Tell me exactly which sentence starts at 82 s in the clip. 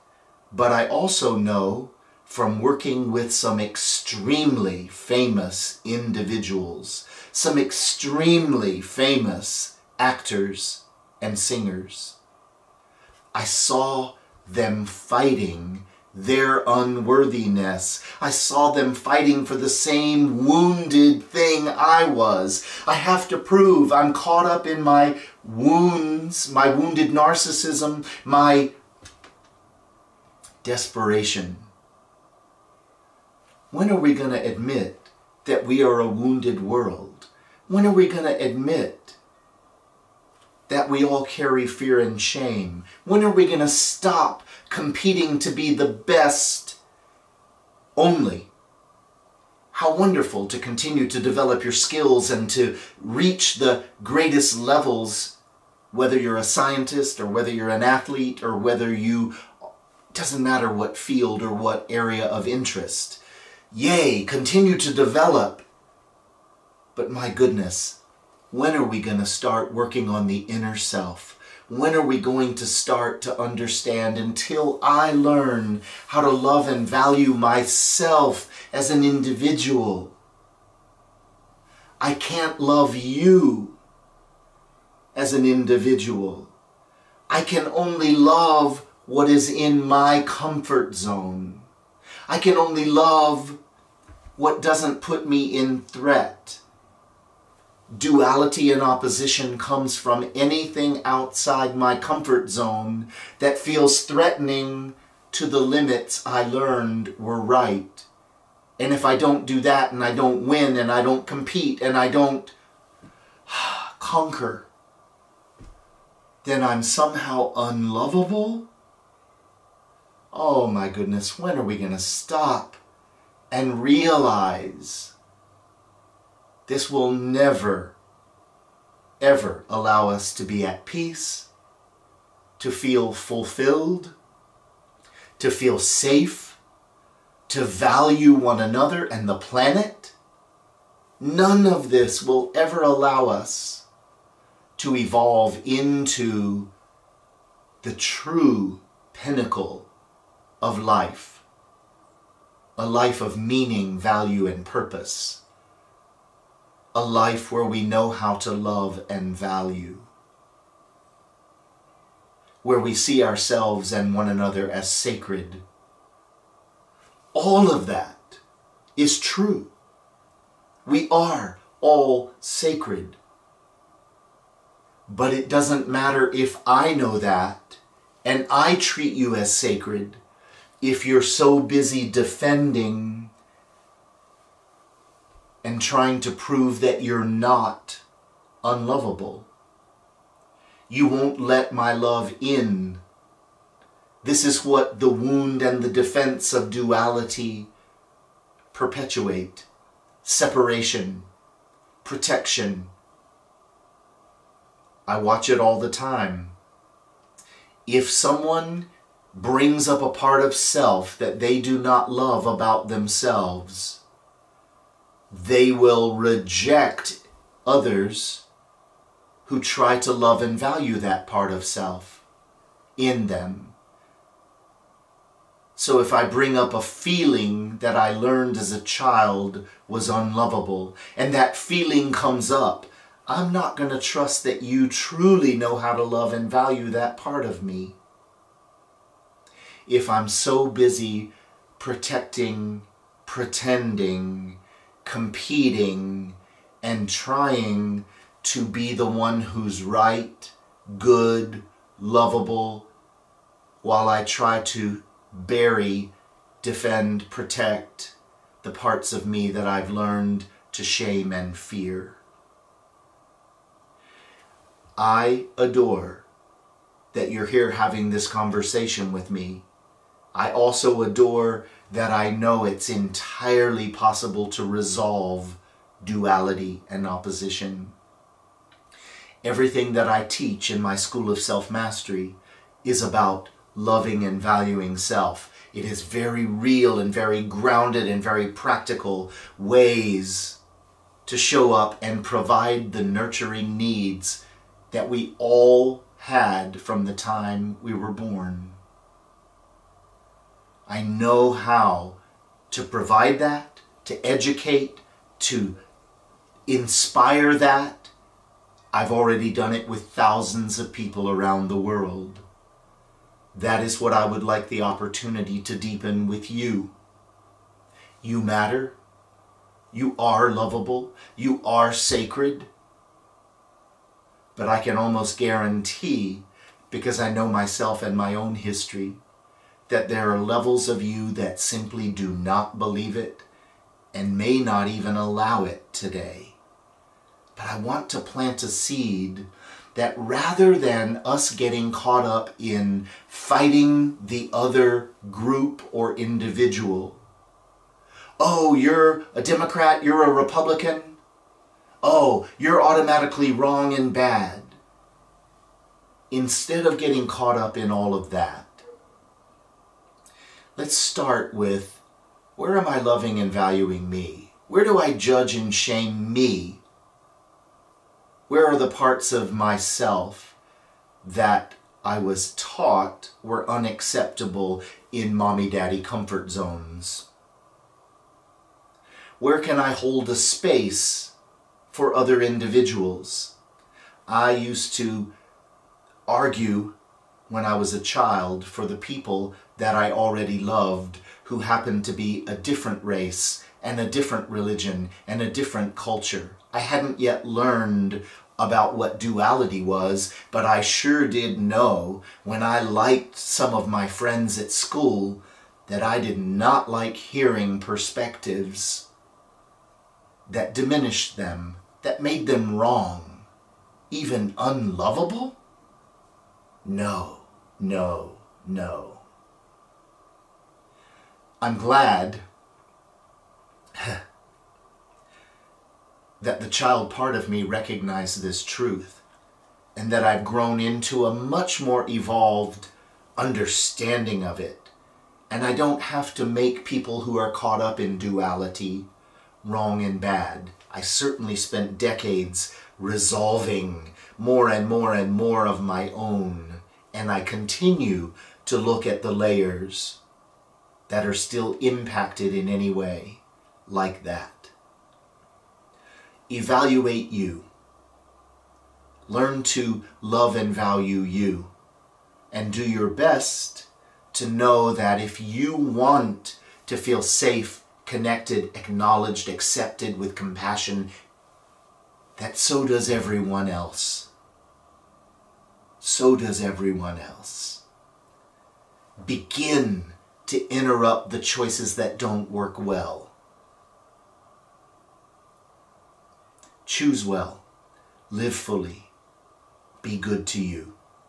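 I can't love you as an individual.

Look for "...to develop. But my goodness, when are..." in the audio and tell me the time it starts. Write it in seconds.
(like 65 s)
64 s.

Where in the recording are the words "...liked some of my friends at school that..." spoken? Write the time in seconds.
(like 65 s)
402 s.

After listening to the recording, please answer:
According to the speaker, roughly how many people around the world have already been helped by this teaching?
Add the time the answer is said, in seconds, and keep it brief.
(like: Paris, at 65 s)
thousands, at 310 s.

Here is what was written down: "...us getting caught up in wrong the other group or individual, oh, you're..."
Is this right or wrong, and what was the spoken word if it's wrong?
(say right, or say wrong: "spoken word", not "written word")
wrong: "fighting", not "wrong".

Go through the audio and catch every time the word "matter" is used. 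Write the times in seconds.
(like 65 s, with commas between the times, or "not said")
60 s, 175 s, 318 s.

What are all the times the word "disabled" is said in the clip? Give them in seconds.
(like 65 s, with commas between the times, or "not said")
not said.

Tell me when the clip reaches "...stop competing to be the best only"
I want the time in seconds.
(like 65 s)
43 s.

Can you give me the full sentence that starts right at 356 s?
Instead of getting caught up in all of that, Let's start with where am I loving and valuing me?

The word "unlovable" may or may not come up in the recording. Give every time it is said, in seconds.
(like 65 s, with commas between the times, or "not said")
117 s, 188 s, 230 s, 414 s.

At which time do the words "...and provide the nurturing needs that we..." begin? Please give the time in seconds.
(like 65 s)
292 s.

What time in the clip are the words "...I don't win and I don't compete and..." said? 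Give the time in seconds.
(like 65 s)
110 s.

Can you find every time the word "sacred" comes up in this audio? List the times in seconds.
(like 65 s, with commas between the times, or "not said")
164 s, 172 s, 179 s, 321 s.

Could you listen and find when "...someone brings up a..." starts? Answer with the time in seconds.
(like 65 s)
208 s.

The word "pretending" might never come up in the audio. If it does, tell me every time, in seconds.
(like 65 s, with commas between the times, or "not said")
243 s.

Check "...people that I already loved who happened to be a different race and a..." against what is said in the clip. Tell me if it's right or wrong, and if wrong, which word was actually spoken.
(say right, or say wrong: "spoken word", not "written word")
right.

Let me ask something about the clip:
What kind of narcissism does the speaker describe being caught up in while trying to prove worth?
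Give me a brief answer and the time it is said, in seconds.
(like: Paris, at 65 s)
wounded narcissism, at 26 s.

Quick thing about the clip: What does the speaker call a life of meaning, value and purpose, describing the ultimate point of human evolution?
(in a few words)
true pinnacle of life.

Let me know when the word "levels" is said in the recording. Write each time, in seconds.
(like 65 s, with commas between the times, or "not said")
54 s, 330 s.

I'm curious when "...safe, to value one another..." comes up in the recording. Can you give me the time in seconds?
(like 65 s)
135 s.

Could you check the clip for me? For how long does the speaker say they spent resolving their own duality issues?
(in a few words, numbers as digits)
decades.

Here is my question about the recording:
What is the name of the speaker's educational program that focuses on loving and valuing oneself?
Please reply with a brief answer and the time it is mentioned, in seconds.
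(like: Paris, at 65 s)
School of Self-Mastery, at 280 s.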